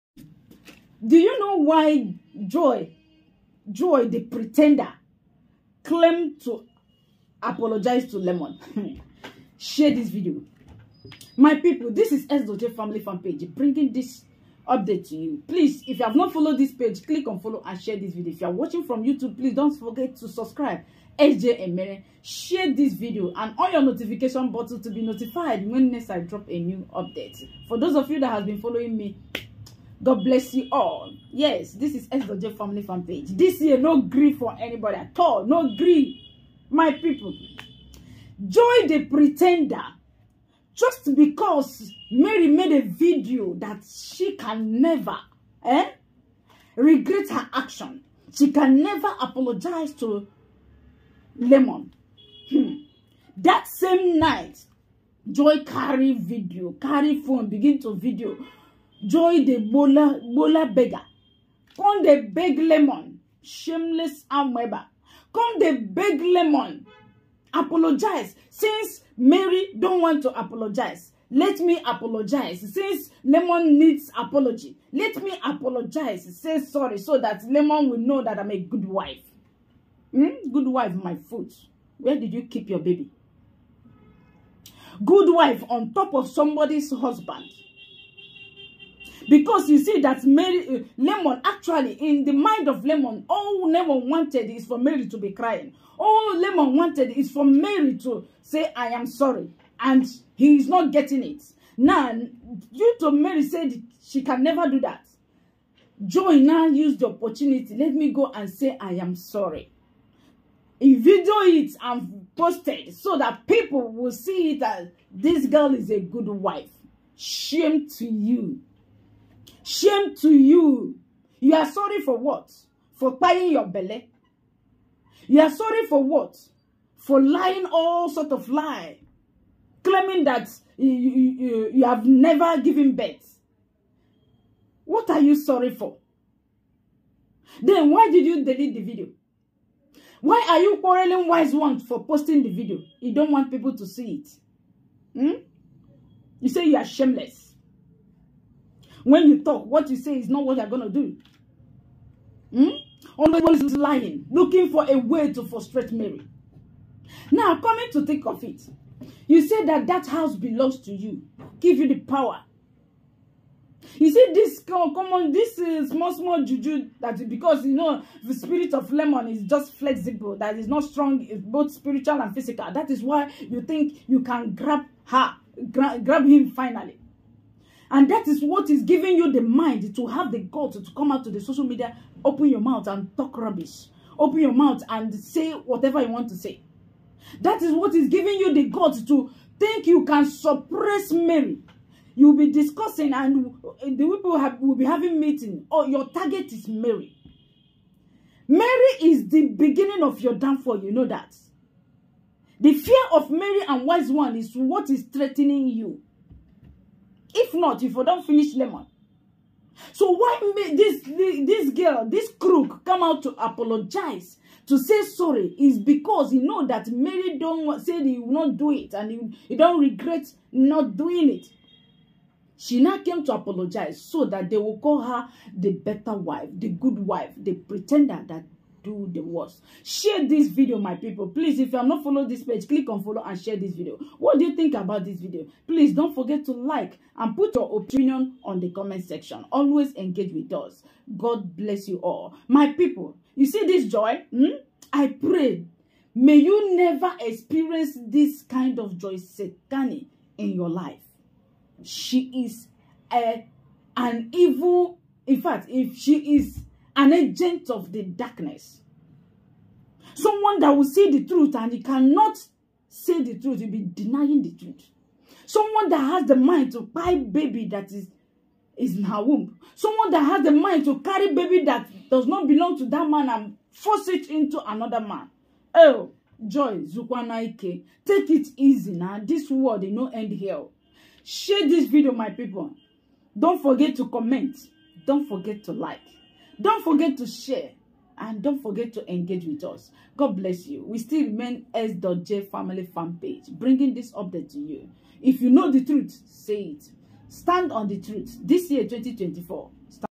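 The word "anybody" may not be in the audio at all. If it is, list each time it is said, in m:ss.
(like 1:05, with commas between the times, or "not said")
0:34.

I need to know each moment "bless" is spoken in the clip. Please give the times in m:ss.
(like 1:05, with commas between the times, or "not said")
0:30, 4:01, 4:50.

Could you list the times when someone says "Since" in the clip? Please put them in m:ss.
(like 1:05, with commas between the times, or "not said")
1:08, 1:12.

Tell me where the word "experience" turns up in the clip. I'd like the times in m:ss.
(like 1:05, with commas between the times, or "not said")
4:07.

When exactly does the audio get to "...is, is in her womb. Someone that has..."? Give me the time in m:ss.
4:27.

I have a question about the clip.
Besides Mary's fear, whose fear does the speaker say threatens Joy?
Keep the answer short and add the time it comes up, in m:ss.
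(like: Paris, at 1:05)
Wise One, at 3:23.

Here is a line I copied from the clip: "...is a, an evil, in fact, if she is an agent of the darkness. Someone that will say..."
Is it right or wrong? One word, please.
right.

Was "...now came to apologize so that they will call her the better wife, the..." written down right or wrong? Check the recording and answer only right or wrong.
right.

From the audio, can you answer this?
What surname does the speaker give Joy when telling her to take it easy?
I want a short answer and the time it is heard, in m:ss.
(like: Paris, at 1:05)
Zukwanaike, at 4:36.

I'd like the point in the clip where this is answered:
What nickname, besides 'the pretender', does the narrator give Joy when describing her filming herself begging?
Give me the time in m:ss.
1:00.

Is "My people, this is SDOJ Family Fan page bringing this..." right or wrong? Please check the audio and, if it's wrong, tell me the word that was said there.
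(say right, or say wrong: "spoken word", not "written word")
right.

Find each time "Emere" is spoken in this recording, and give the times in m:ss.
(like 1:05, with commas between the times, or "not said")
0:21.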